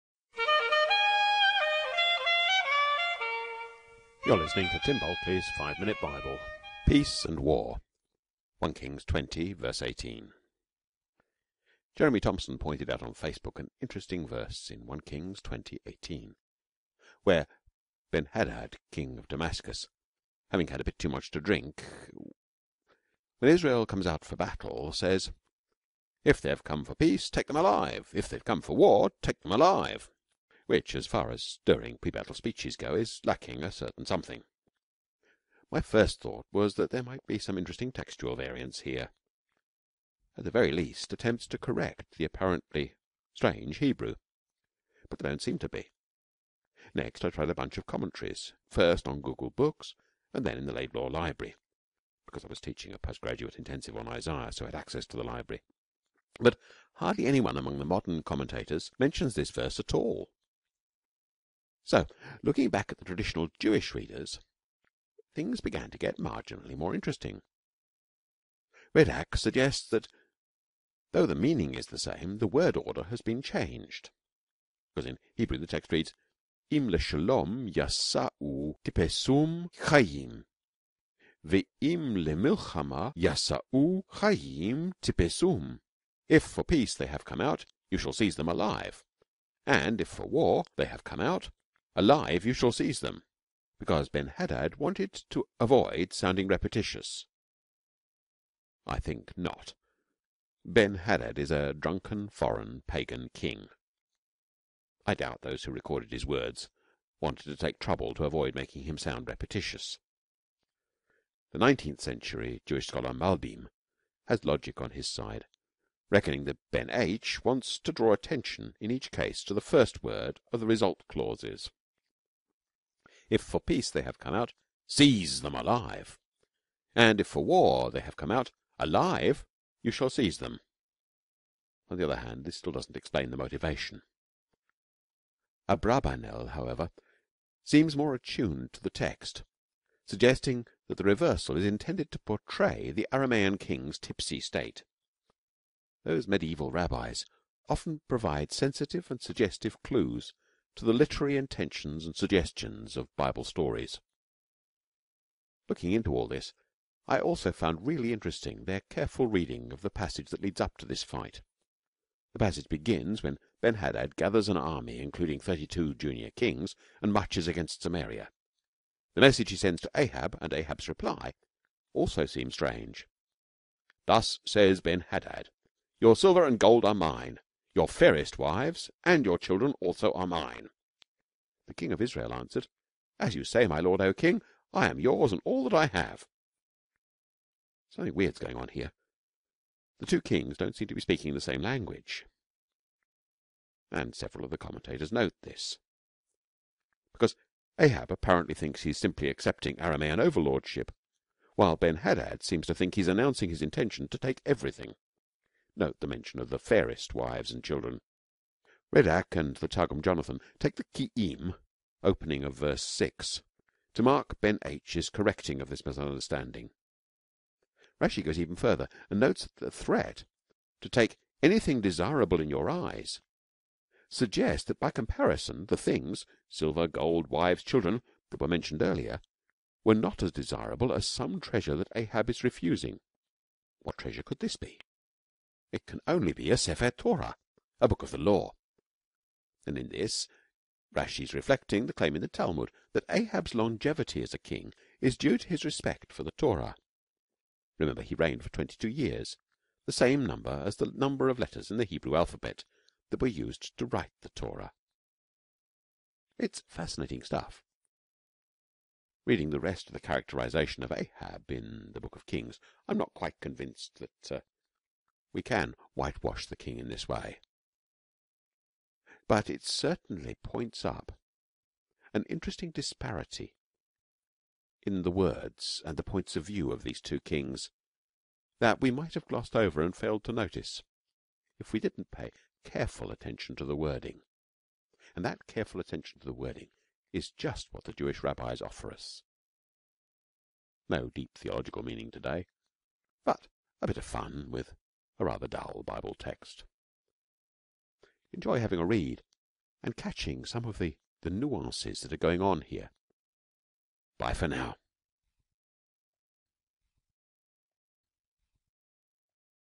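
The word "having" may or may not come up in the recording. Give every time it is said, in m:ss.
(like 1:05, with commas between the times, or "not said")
0:20, 4:58.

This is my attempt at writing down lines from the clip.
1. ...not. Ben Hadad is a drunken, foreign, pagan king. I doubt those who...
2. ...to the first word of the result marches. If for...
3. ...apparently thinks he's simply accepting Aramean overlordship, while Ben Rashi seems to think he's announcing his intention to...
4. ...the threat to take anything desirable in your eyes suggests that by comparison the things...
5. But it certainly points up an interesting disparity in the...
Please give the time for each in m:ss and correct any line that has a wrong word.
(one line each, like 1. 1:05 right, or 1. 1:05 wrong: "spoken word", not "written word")
1. 1:39 right
2. 1:59 wrong: "clauses", not "marches"
3. 3:18 wrong: "Hadad", not "Rashi"
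4. 3:39 right
5. 4:29 right.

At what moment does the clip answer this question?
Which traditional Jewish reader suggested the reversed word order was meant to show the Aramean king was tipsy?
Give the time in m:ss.
2:15.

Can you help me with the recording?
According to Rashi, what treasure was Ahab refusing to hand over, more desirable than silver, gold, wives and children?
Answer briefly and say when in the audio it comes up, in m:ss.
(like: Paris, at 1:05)
Sefer Torah, at 3:56.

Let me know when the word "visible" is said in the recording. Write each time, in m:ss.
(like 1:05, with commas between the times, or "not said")
not said.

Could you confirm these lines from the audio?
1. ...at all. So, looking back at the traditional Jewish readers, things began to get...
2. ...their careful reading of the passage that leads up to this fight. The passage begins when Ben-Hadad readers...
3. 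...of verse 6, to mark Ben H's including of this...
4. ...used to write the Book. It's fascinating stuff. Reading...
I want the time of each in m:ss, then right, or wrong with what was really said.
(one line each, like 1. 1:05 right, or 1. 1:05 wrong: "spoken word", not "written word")
1. 0:59 right
2. 2:38 wrong: "gathers", not "readers"
3. 3:32 wrong: "correcting", not "including"
4. 4:13 wrong: "Torah", not "Book".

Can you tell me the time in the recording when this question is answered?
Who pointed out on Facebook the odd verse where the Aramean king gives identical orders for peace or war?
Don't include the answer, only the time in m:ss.
0:11.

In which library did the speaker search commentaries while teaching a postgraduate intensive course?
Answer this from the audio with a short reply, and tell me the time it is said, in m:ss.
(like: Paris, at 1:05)
Laidlaw Library, at 0:50.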